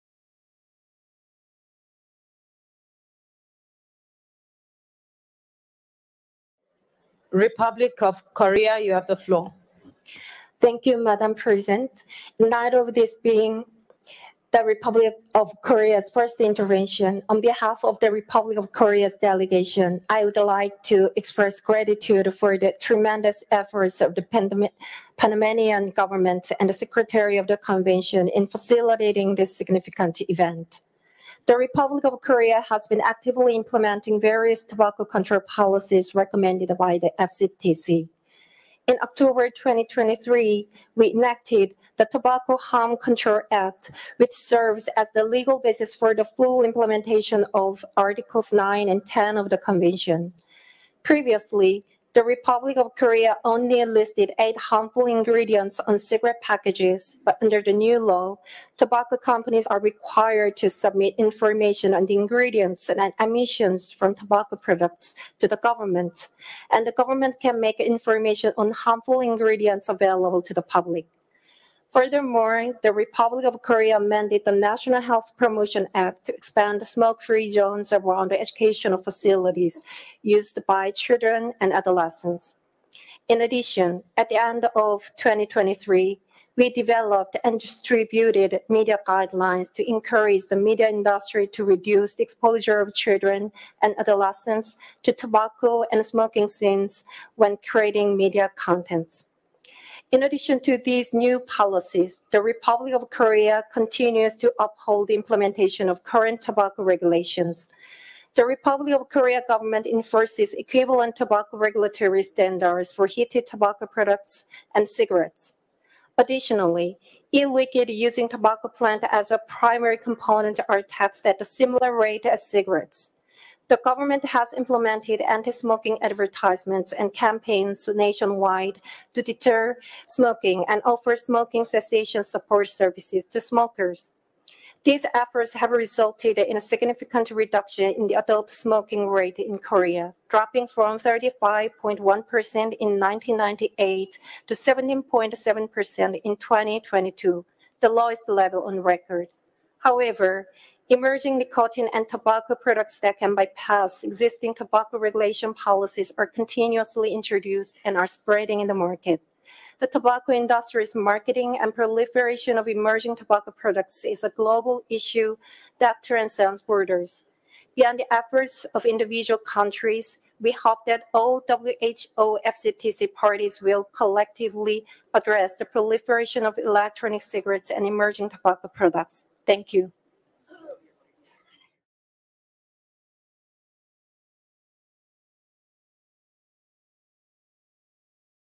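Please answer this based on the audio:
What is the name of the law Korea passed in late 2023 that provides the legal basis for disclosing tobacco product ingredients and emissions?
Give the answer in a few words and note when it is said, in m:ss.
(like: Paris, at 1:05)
Tobacco Harm Control Act, at 0:42.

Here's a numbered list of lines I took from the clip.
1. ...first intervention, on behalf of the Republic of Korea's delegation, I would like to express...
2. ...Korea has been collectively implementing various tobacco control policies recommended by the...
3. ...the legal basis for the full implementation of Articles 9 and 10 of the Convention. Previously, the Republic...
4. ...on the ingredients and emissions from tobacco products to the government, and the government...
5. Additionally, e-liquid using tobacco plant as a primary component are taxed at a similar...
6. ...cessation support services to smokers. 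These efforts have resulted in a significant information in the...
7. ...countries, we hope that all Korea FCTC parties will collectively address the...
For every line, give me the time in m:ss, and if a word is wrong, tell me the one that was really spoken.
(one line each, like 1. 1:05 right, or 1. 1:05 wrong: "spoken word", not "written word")
1. 0:16 right
2. 0:32 wrong: "actively", not "collectively"
3. 0:45 right
4. 1:01 right
5. 1:56 right
6. 2:11 wrong: "reduction", not "information"
7. 2:49 wrong: "WHO", not "Korea".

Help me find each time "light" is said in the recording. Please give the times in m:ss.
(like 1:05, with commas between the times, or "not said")
0:12.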